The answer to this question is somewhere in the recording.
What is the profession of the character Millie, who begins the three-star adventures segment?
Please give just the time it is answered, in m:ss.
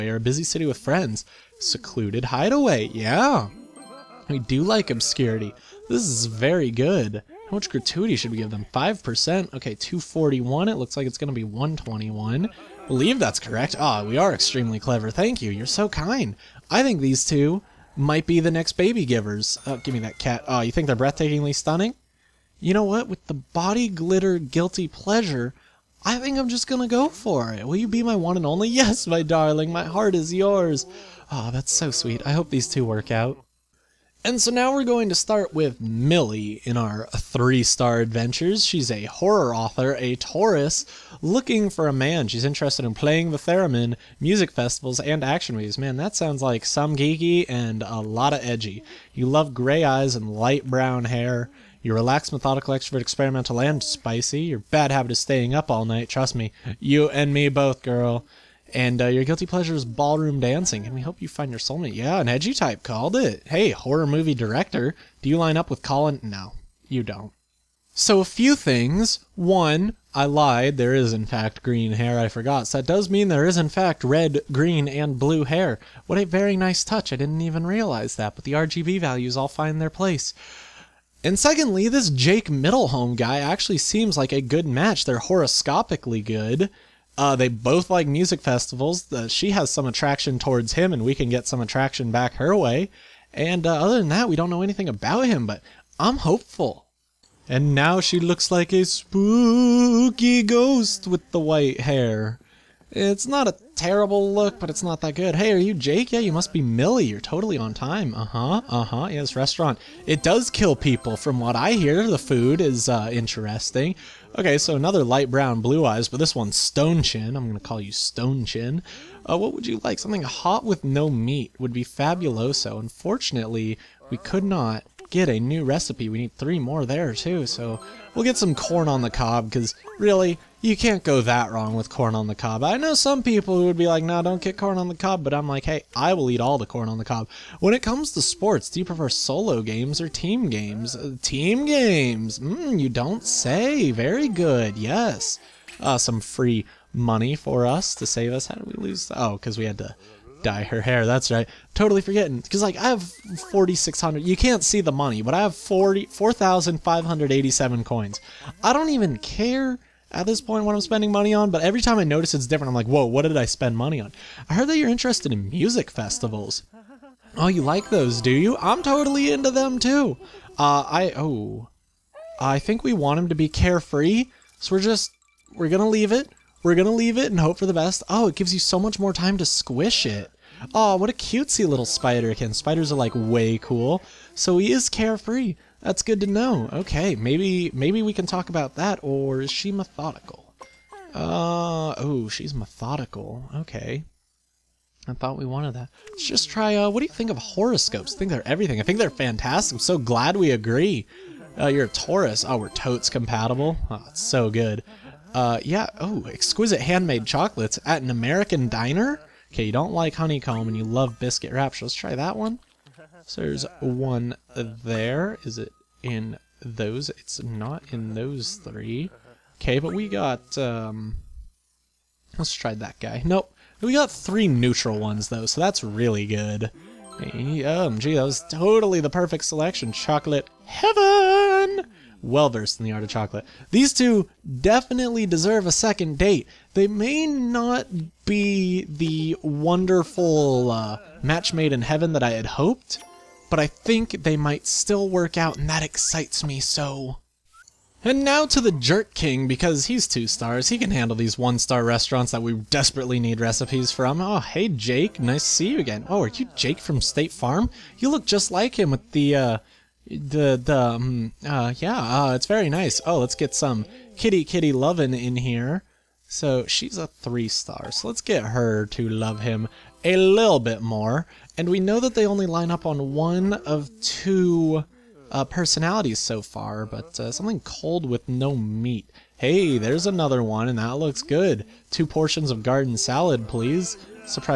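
0:39.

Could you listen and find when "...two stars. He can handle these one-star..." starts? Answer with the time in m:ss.
4:10.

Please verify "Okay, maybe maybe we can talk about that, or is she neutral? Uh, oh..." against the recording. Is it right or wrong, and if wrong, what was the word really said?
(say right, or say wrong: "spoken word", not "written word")
wrong: "methodical", not "neutral".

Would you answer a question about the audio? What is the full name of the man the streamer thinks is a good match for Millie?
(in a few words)
Jake Middlehome.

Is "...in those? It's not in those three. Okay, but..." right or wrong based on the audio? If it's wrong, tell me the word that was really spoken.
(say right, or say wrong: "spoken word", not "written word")
right.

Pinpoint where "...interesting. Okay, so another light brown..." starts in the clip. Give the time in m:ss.
1:53.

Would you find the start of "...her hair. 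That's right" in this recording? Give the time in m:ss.
2:30.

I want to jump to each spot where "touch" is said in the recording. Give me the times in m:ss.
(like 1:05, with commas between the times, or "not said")
1:16.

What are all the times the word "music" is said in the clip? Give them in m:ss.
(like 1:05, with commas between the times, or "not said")
0:44, 1:28, 2:45.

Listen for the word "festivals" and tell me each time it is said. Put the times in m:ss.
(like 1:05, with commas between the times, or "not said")
0:44, 1:28, 2:45.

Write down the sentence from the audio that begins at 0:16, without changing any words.
I think these two might be the next baby givers.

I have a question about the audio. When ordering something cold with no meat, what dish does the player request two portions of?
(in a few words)
Garden salad.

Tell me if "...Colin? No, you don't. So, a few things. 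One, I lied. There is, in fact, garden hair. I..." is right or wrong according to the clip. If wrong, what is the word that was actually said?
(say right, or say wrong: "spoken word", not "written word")
wrong: "green", not "garden".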